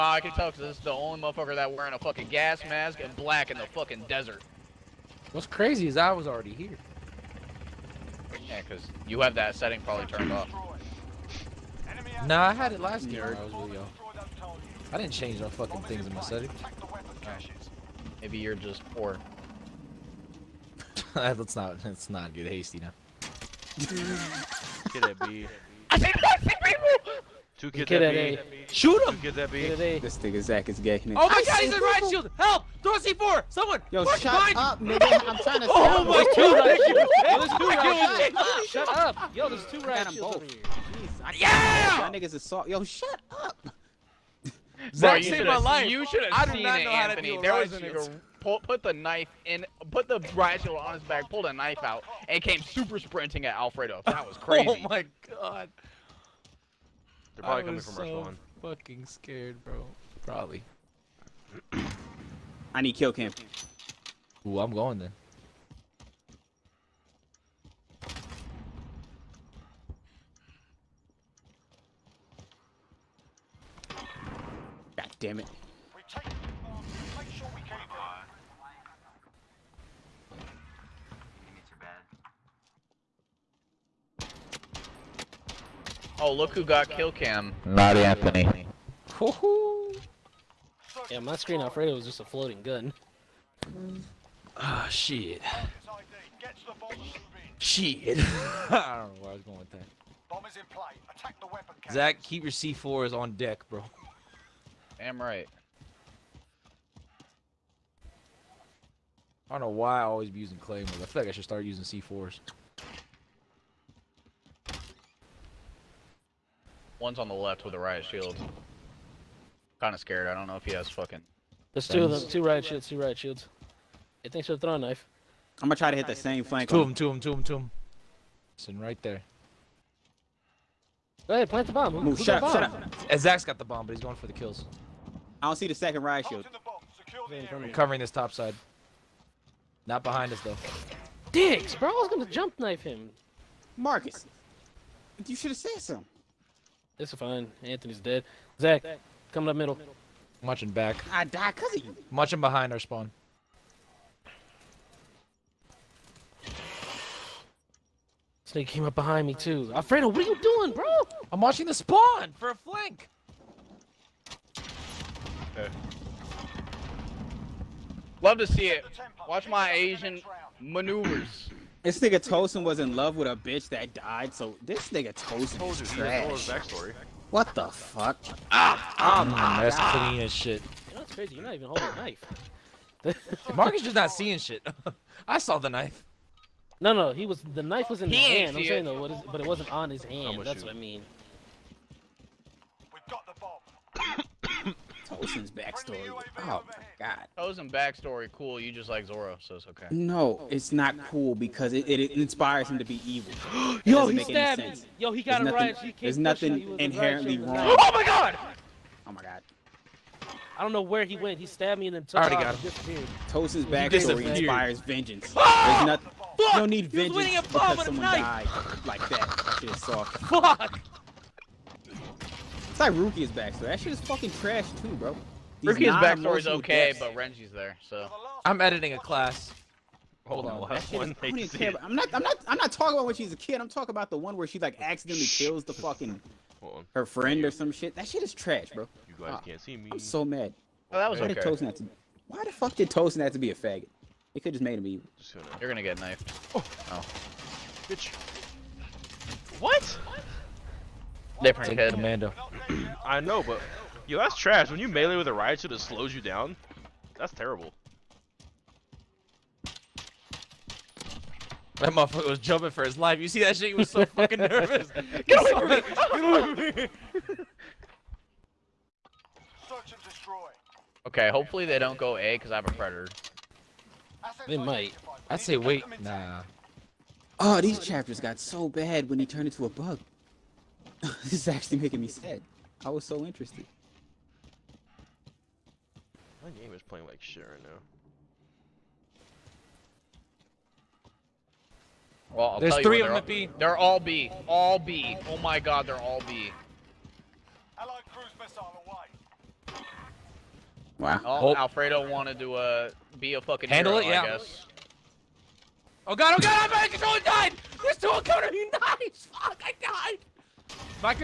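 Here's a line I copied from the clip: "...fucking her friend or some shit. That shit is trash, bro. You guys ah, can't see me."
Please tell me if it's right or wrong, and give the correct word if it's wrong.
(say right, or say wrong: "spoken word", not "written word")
right.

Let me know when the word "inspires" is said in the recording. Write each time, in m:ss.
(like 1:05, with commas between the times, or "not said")
3:22, 3:34.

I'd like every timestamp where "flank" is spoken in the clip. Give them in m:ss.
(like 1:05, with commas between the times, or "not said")
2:06, 2:42.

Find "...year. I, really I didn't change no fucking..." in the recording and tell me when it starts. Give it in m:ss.
0:13.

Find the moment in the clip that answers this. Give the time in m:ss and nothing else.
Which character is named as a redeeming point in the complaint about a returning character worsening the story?
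3:47.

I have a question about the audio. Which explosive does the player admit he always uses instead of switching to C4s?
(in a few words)
Claymores.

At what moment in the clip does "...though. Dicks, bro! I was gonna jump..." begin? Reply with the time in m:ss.
2:20.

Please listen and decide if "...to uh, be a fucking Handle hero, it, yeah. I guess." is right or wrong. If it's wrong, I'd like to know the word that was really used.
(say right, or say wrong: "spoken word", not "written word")
right.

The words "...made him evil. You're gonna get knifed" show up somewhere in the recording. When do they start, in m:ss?
4:04.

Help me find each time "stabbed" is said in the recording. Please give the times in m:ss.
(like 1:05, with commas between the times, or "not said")
3:24, 3:31.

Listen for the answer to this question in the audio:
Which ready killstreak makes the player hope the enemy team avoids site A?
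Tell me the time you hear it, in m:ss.
4:32.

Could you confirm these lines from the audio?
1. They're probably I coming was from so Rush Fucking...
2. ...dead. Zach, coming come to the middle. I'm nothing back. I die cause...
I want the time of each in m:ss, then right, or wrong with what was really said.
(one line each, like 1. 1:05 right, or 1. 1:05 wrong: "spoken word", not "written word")
1. 0:57 right
2. 2:27 wrong: "watching", not "nothing".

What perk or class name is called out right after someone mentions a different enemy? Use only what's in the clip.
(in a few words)
Commando.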